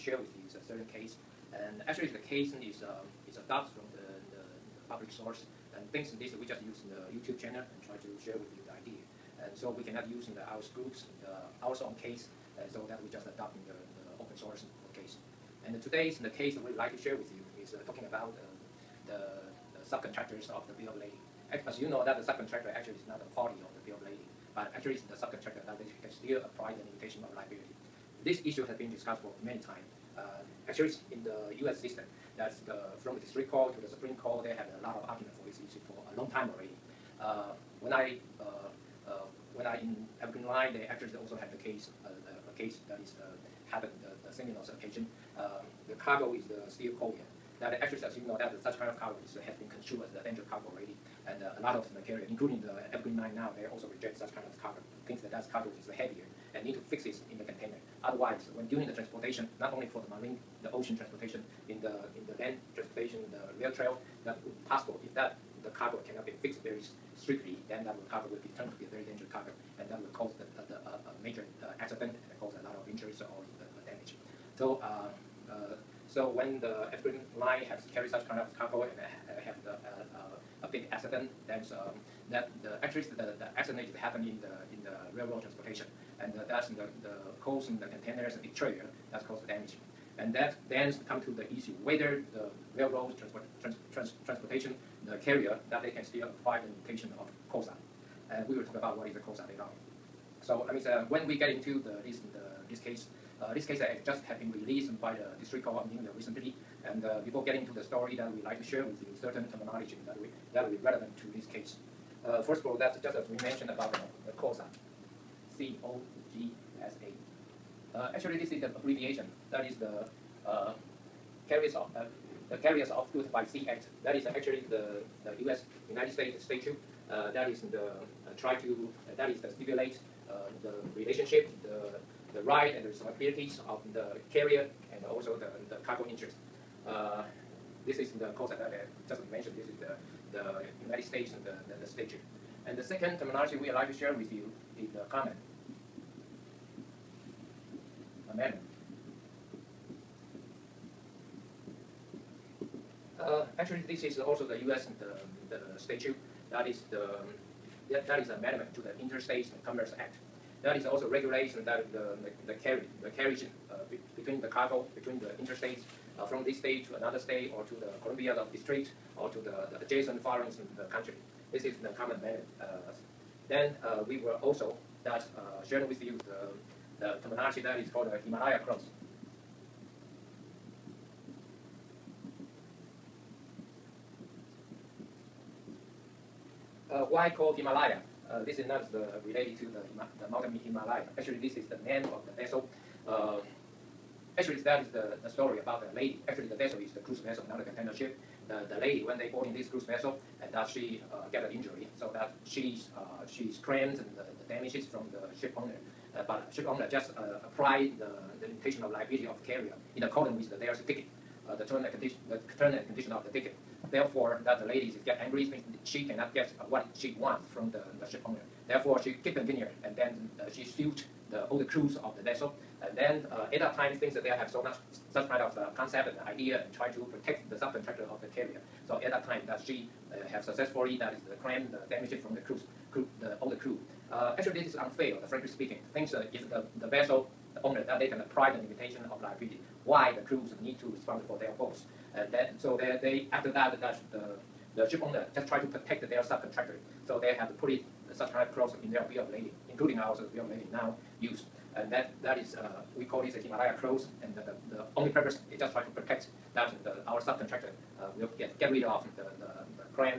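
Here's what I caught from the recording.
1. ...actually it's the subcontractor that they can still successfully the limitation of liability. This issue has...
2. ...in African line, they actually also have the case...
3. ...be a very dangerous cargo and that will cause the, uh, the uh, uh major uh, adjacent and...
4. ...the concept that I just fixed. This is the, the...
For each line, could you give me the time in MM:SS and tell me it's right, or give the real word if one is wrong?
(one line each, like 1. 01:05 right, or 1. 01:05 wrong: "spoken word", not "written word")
1. 00:24 wrong: "apply", not "successfully"
2. 00:39 right
3. 01:08 wrong: "accident", not "adjacent"
4. 02:18 wrong: "mentioned", not "fixed".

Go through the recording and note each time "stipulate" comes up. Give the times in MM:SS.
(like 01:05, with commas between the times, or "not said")
02:09.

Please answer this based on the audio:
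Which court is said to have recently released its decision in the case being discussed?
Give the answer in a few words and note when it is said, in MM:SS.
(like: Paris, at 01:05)
District Court of New York, at 01:45.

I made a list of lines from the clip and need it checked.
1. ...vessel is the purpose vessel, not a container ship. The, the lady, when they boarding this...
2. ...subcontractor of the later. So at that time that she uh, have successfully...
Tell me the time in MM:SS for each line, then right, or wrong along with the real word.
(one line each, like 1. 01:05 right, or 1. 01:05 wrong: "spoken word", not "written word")
1. 03:16 wrong: "cruise", not "purpose"
2. 03:47 wrong: "carrier", not "later".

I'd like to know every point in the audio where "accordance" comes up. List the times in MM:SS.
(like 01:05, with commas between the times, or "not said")
03:30.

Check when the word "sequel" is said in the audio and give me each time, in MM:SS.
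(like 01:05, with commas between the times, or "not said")
not said.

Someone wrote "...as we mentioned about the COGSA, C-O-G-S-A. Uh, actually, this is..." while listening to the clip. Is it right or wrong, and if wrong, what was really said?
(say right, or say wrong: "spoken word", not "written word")
right.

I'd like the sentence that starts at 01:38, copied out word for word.
And we will talk about what is the COGSA later on.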